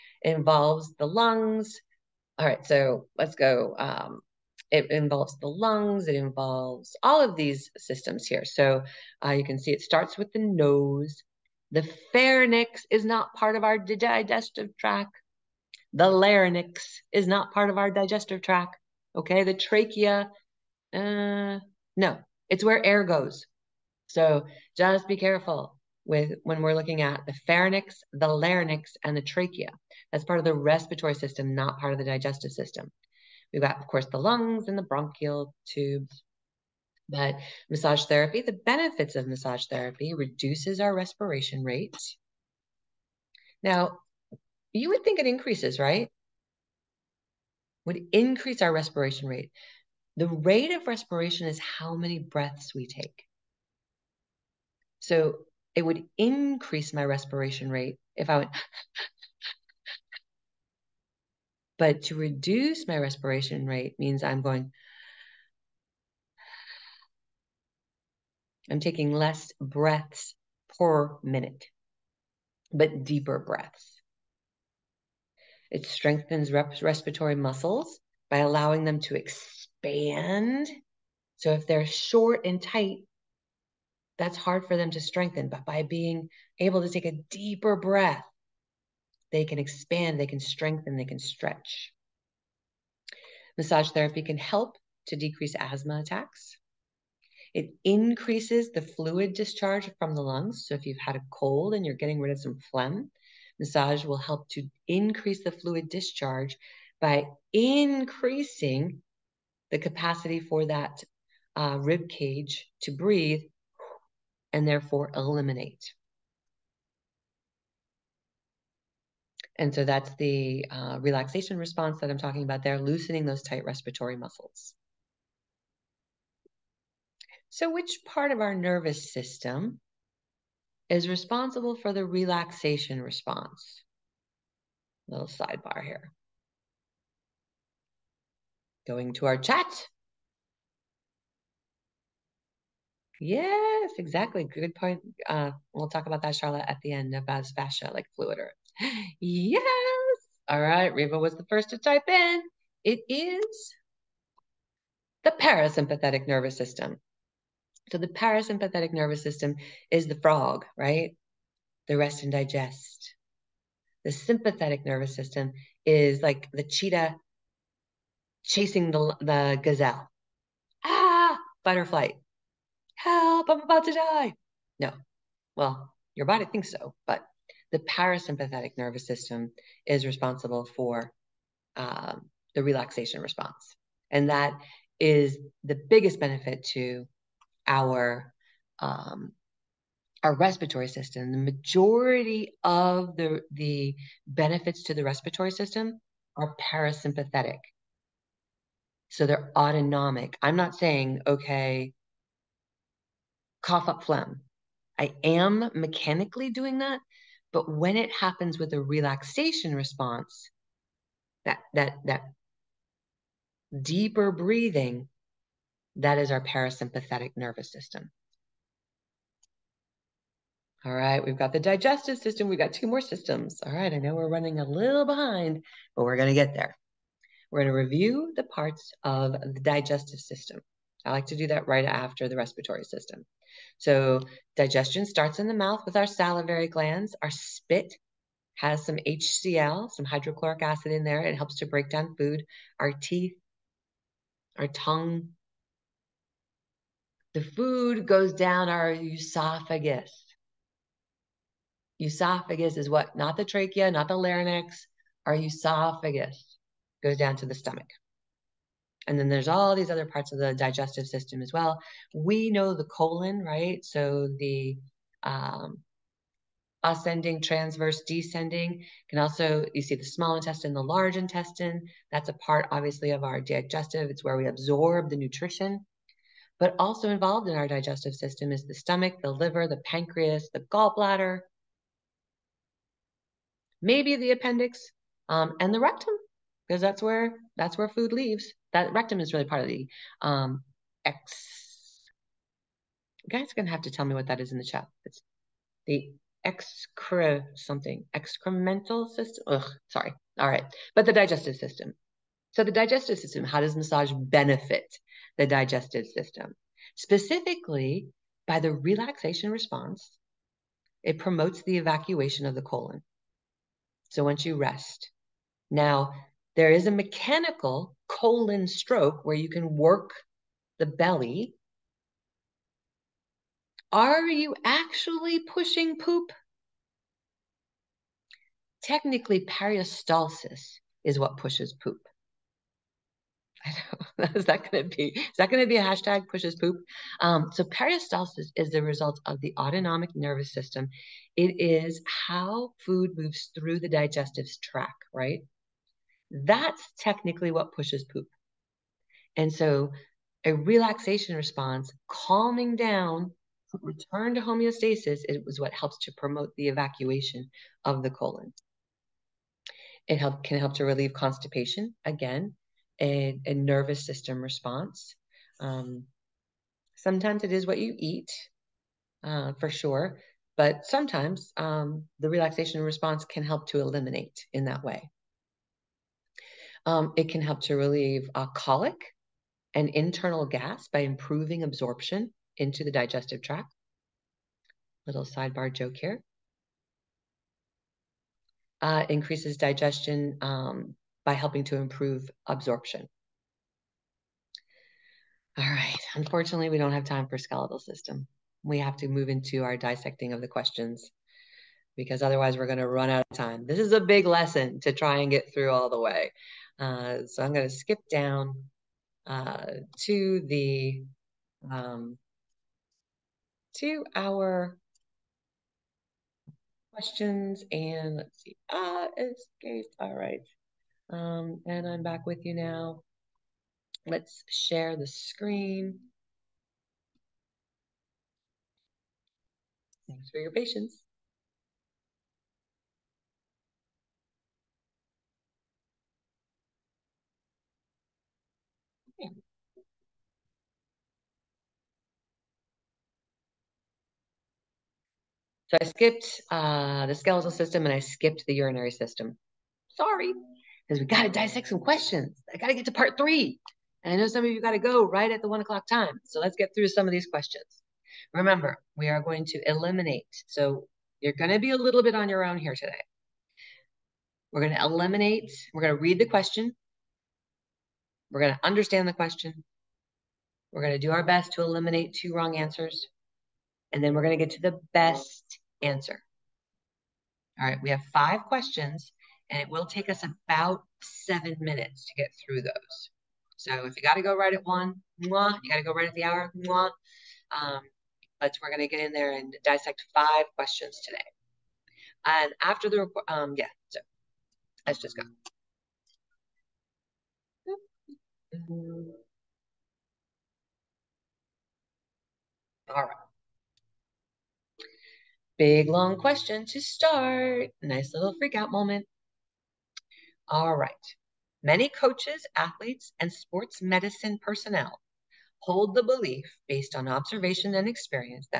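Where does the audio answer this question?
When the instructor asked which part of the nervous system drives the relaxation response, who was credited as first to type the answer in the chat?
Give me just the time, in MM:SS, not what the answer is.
02:30.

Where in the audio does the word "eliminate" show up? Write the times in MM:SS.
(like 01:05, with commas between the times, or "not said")
01:55, 06:13, 07:39, 07:44, 07:51.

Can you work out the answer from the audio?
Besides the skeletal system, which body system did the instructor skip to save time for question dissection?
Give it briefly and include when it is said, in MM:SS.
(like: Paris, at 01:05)
urinary system, at 07:28.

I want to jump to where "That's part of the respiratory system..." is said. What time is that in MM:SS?
00:30.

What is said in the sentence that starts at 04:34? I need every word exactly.
It's where we absorb the nutrition.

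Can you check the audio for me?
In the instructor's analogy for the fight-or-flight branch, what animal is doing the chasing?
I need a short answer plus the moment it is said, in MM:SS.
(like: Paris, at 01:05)
cheetah, at 02:46.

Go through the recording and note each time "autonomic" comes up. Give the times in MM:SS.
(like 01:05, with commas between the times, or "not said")
03:19, 05:39.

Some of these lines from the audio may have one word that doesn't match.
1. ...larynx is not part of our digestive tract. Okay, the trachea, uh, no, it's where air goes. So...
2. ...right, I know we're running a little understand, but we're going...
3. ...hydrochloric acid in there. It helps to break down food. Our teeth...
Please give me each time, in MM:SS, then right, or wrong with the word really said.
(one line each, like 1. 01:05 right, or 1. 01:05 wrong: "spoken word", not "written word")
1. 00:16 right
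2. 03:43 wrong: "behind", not "understand"
3. 04:00 right.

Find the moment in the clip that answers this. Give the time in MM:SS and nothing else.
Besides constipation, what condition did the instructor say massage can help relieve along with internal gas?
06:18.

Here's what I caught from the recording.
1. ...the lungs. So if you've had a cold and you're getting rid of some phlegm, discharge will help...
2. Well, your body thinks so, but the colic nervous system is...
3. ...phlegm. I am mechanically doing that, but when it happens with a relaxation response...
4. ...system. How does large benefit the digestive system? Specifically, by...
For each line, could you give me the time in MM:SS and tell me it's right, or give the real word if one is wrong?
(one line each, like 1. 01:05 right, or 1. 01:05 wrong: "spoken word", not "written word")
1. 01:40 wrong: "massage", not "discharge"
2. 02:55 wrong: "parasympathetic", not "colic"
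3. 03:24 right
4. 05:03 wrong: "massage", not "large".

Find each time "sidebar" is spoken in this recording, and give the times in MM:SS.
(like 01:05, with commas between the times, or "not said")
02:15, 06:25.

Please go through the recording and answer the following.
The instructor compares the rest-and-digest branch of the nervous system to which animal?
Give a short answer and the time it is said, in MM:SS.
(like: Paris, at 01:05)
frog, at 02:40.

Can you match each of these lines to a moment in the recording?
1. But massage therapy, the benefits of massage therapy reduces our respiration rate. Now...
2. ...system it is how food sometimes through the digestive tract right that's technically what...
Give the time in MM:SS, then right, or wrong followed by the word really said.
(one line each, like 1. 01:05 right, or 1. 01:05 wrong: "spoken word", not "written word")
1. 00:37 right
2. 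05:40 wrong: "moves", not "sometimes".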